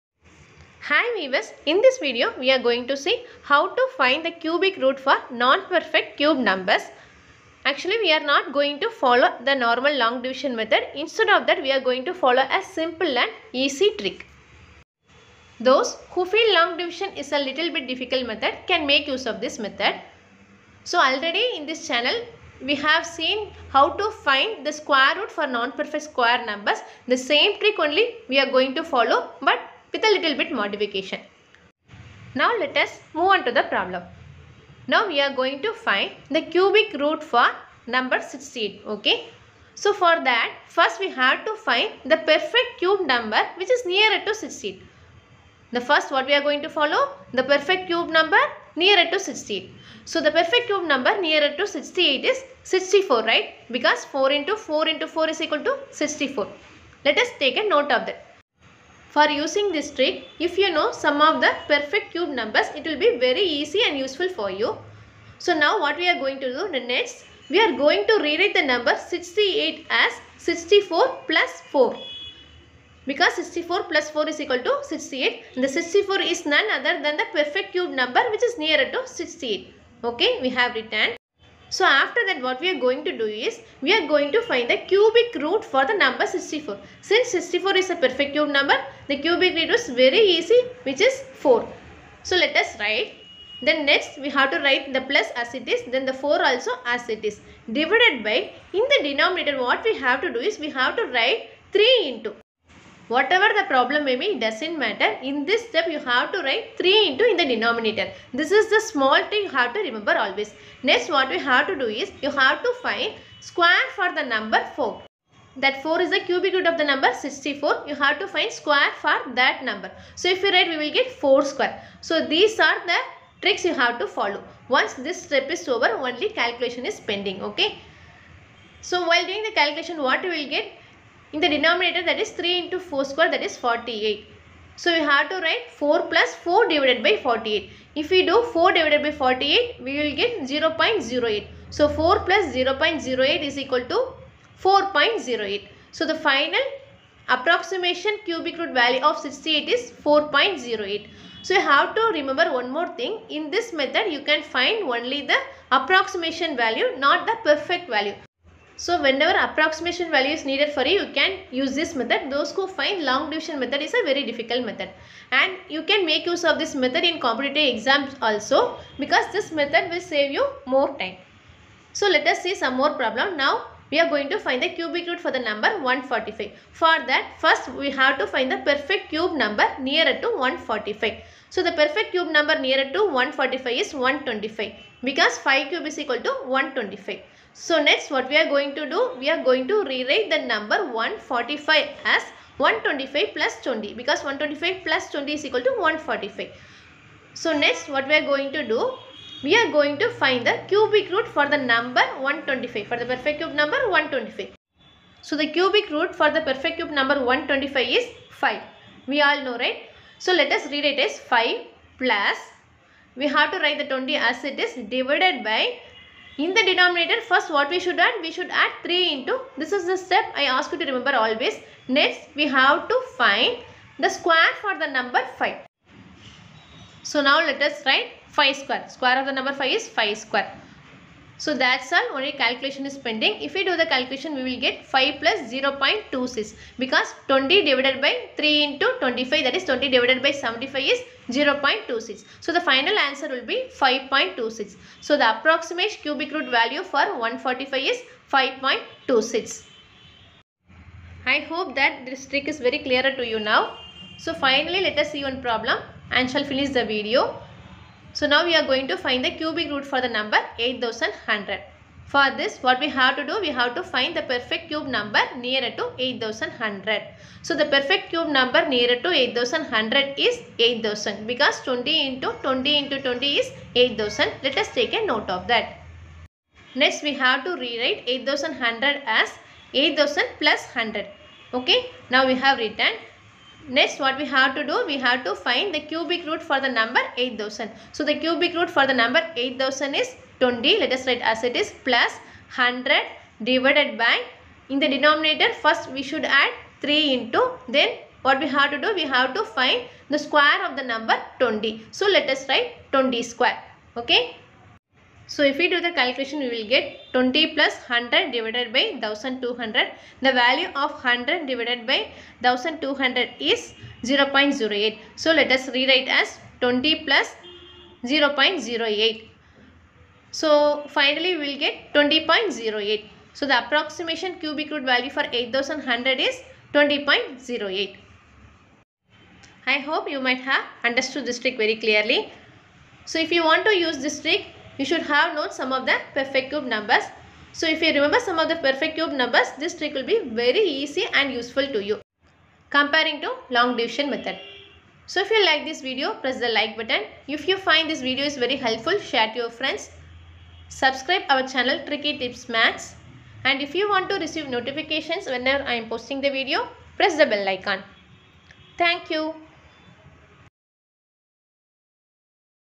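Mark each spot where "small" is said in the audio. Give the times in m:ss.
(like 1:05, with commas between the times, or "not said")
1:48.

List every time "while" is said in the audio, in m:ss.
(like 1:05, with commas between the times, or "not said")
2:09.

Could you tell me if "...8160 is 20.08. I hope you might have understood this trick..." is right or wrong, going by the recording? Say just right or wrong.
wrong.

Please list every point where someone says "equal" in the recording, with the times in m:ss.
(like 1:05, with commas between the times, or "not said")
0:55, 1:14, 2:23, 3:05, 3:15.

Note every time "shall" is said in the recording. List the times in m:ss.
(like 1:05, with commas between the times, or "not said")
4:16.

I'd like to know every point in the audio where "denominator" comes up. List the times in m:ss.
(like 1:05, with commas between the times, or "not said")
1:39, 1:47, 2:11, 3:36, 4:54.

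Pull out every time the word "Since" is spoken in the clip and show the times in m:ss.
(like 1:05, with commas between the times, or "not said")
1:27.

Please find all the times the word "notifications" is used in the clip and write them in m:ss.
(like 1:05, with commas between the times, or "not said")
5:54.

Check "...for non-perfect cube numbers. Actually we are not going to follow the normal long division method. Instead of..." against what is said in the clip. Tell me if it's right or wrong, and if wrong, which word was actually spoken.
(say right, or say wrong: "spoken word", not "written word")
right.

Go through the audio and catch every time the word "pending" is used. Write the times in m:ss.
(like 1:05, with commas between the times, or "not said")
2:07, 3:52.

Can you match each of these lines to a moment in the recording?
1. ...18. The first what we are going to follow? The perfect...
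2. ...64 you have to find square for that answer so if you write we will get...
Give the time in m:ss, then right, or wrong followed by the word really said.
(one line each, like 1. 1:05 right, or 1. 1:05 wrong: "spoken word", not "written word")
1. 0:44 wrong: "16", not "18"
2. 1:57 wrong: "number", not "answer".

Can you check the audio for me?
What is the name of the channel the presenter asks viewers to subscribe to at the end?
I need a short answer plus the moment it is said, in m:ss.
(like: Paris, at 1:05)
Tricky Tips Maths, at 5:51.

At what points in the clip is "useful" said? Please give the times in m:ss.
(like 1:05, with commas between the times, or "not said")
1:03, 5:41.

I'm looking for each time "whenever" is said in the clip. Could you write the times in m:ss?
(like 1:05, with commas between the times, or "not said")
2:39, 5:55.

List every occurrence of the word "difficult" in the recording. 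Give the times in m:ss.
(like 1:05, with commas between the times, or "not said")
0:17, 2:44.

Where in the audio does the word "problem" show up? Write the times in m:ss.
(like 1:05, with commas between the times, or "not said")
0:33, 1:43, 2:52, 4:15.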